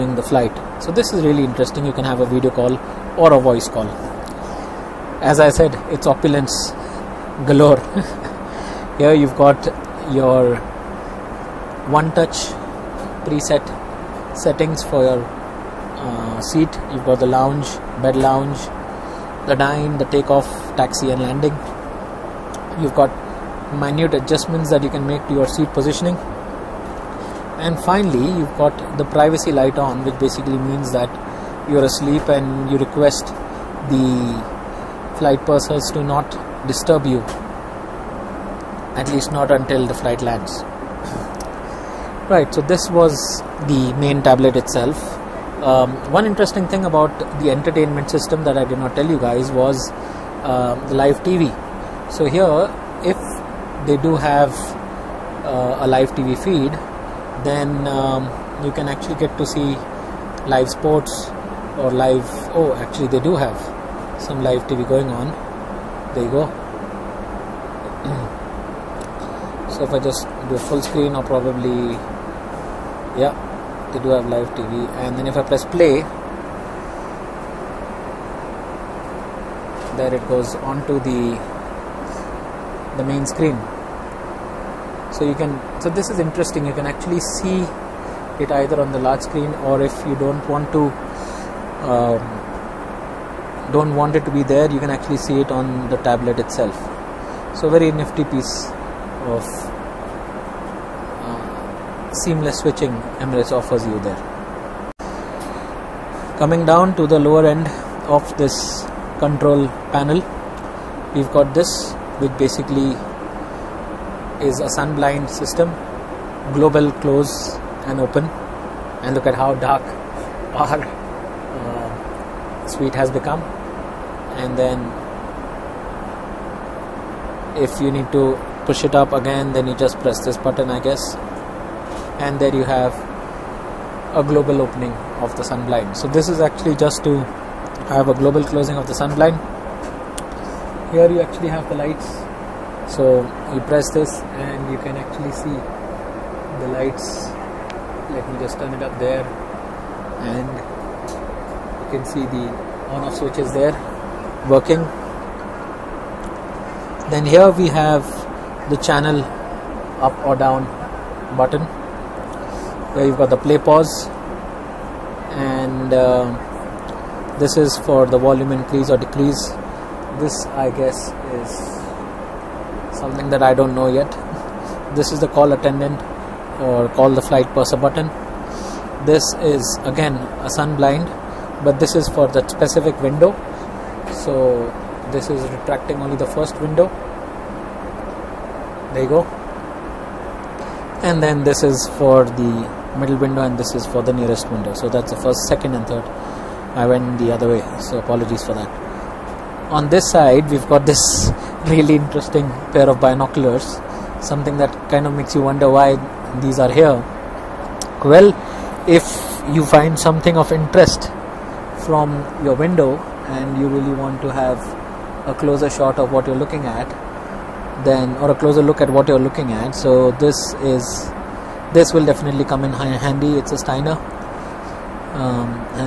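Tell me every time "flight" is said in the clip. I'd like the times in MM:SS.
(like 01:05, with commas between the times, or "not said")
00:00, 00:35, 00:39, 02:57.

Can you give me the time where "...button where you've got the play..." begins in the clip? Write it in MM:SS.
02:41.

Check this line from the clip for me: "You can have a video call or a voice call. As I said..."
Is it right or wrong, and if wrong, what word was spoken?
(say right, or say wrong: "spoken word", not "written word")
right.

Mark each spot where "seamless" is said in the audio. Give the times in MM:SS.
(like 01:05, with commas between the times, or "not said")
01:42.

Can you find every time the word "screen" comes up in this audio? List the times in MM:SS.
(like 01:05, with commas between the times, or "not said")
01:10, 01:23, 01:29.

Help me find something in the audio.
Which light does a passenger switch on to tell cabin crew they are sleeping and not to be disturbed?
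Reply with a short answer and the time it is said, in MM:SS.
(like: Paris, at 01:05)
privacy light, at 00:29.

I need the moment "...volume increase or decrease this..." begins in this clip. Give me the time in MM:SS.
02:48.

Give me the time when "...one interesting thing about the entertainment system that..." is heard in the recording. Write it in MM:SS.
00:46.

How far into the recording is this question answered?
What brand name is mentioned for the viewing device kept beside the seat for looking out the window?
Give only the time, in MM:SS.
03:43.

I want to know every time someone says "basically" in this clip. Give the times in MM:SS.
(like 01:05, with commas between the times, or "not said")
00:30, 01:52.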